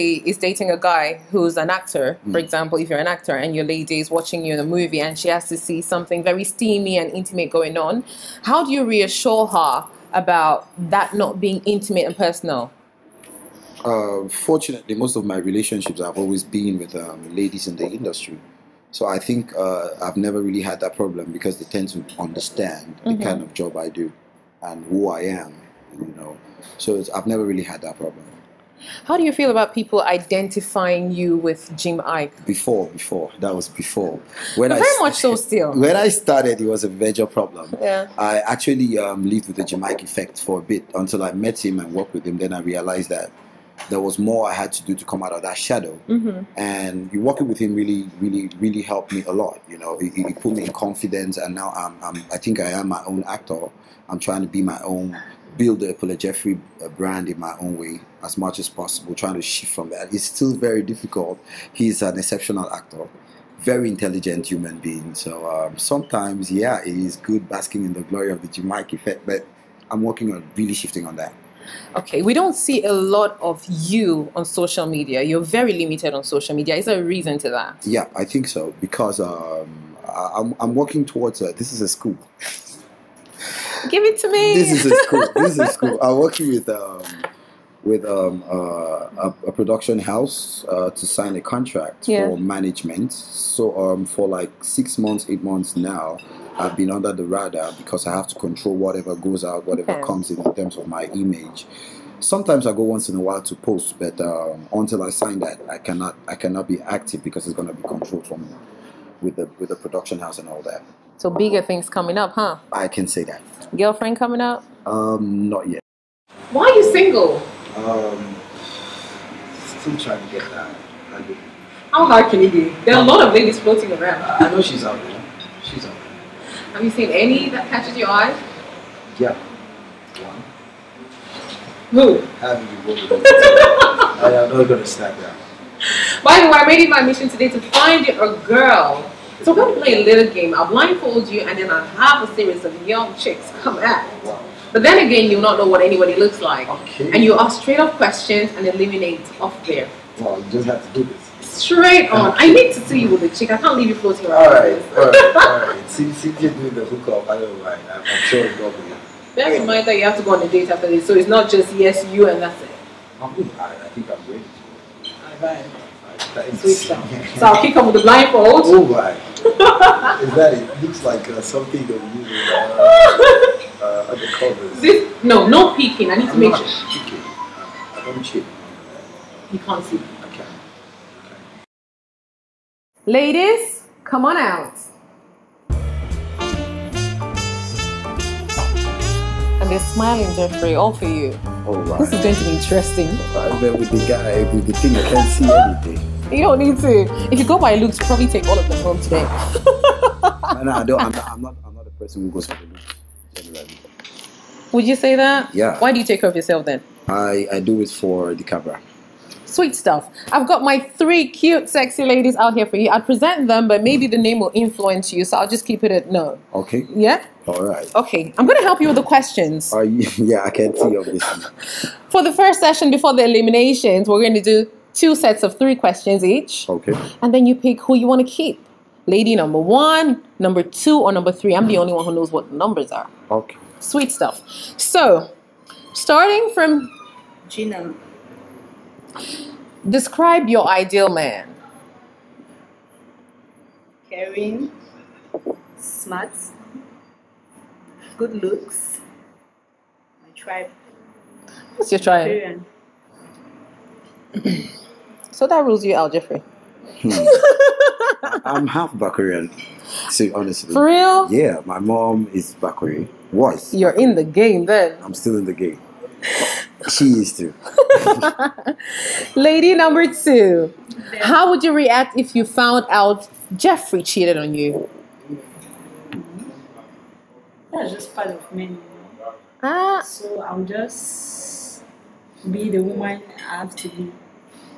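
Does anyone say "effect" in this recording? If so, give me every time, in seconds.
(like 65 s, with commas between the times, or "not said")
40 s, 68 s.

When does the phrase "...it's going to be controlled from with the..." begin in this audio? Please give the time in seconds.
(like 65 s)
107 s.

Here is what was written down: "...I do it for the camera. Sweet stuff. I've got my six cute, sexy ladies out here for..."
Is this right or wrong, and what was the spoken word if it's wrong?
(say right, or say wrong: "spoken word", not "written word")
wrong: "three", not "six".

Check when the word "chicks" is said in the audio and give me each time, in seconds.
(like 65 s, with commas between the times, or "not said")
143 s, 153 s.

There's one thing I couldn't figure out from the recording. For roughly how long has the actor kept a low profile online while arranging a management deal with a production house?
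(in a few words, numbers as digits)
6 to 8 months.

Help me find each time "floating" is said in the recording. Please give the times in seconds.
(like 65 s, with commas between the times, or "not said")
123 s, 153 s.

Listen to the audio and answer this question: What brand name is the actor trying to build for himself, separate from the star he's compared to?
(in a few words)
Epule Jeffrey.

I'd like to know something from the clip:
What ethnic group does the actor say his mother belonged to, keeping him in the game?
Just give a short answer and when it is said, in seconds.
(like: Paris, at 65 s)
Bakweri, at 262 s.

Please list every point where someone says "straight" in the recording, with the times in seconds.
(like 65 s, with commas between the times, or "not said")
147 s, 151 s.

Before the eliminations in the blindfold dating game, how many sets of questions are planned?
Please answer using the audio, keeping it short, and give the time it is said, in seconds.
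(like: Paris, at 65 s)
2, at 224 s.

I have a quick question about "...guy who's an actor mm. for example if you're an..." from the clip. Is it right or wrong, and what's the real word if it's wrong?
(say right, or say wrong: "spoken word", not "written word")
right.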